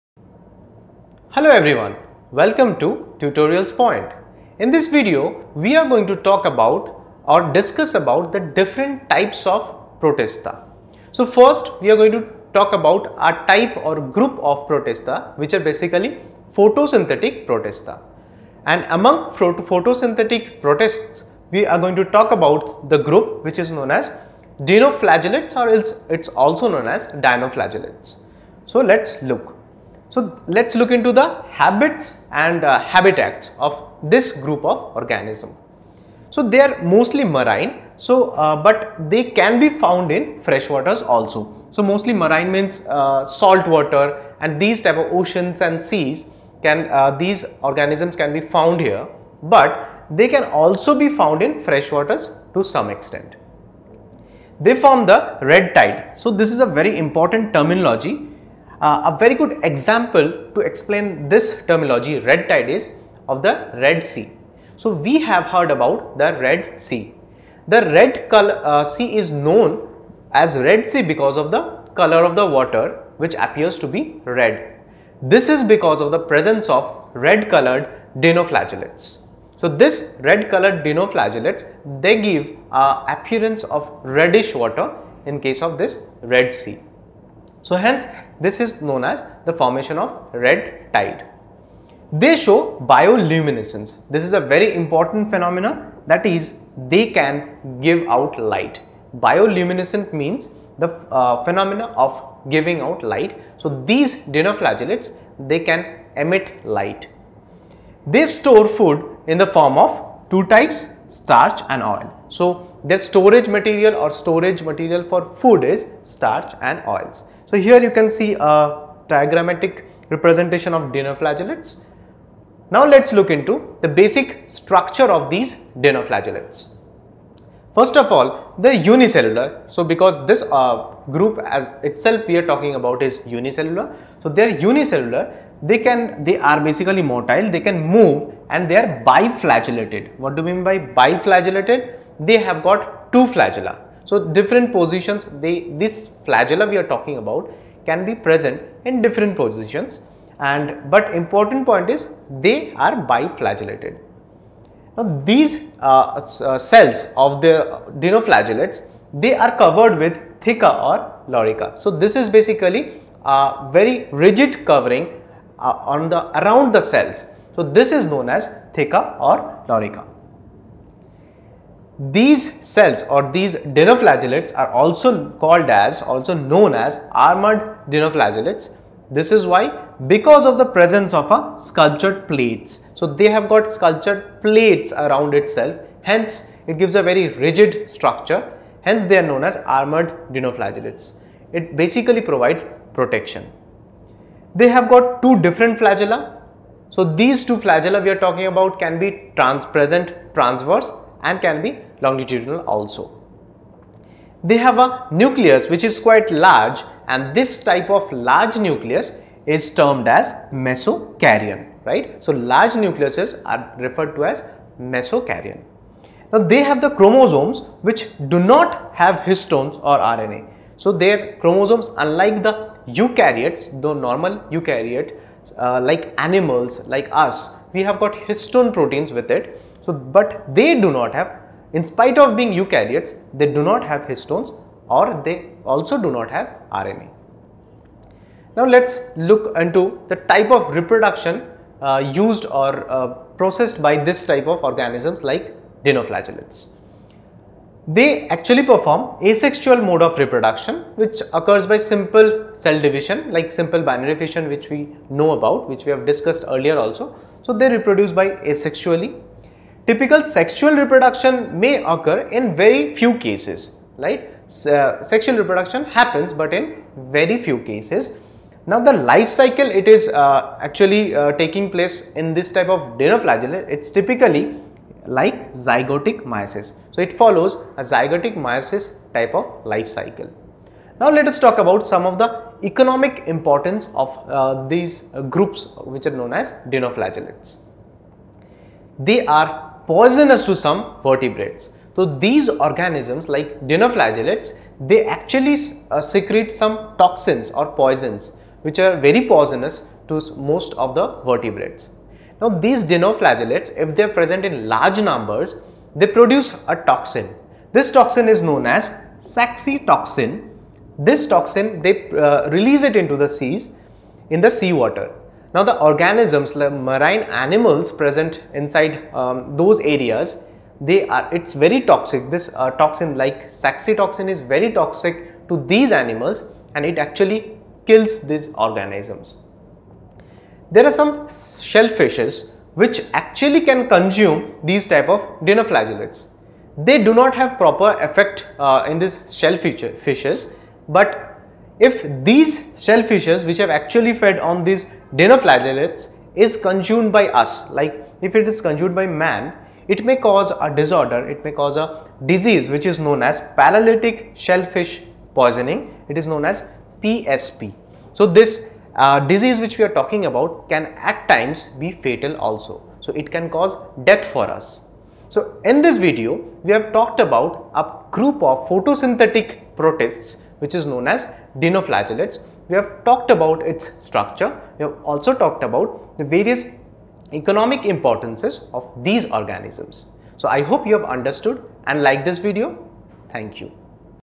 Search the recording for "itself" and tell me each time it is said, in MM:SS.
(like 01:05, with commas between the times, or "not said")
02:11, 03:05.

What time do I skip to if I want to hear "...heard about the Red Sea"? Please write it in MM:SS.
01:05.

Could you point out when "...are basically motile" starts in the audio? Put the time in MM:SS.
02:16.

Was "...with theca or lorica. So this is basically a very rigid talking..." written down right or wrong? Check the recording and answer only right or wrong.
wrong.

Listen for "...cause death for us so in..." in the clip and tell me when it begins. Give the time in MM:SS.
06:03.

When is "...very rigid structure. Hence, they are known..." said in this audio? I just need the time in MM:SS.
03:07.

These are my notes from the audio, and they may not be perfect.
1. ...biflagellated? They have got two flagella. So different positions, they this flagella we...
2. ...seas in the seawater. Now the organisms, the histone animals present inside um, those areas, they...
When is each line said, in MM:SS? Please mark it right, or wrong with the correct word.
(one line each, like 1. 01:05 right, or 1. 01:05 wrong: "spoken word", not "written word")
1. 02:20 right
2. 05:13 wrong: "marine", not "histone".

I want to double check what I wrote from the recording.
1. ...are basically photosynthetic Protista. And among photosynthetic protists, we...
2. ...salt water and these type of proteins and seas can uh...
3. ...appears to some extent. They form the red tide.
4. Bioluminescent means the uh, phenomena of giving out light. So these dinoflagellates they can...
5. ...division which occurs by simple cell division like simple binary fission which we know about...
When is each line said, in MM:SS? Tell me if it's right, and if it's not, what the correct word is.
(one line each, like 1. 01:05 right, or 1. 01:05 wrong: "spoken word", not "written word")
1. 00:15 right
2. 00:43 wrong: "oceans", not "proteins"
3. 00:51 wrong: "freshwaters", not "appears"
4. 01:39 right
5. 04:10 wrong: "reproduction", not "division".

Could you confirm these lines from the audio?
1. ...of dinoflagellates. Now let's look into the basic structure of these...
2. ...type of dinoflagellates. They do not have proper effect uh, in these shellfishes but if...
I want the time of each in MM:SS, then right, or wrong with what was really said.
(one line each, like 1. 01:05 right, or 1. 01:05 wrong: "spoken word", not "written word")
1. 02:00 right
2. 05:34 right.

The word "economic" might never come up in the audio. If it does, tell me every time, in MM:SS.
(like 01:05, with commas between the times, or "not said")
04:42, 06:17.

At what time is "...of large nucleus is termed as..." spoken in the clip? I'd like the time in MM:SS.
03:27.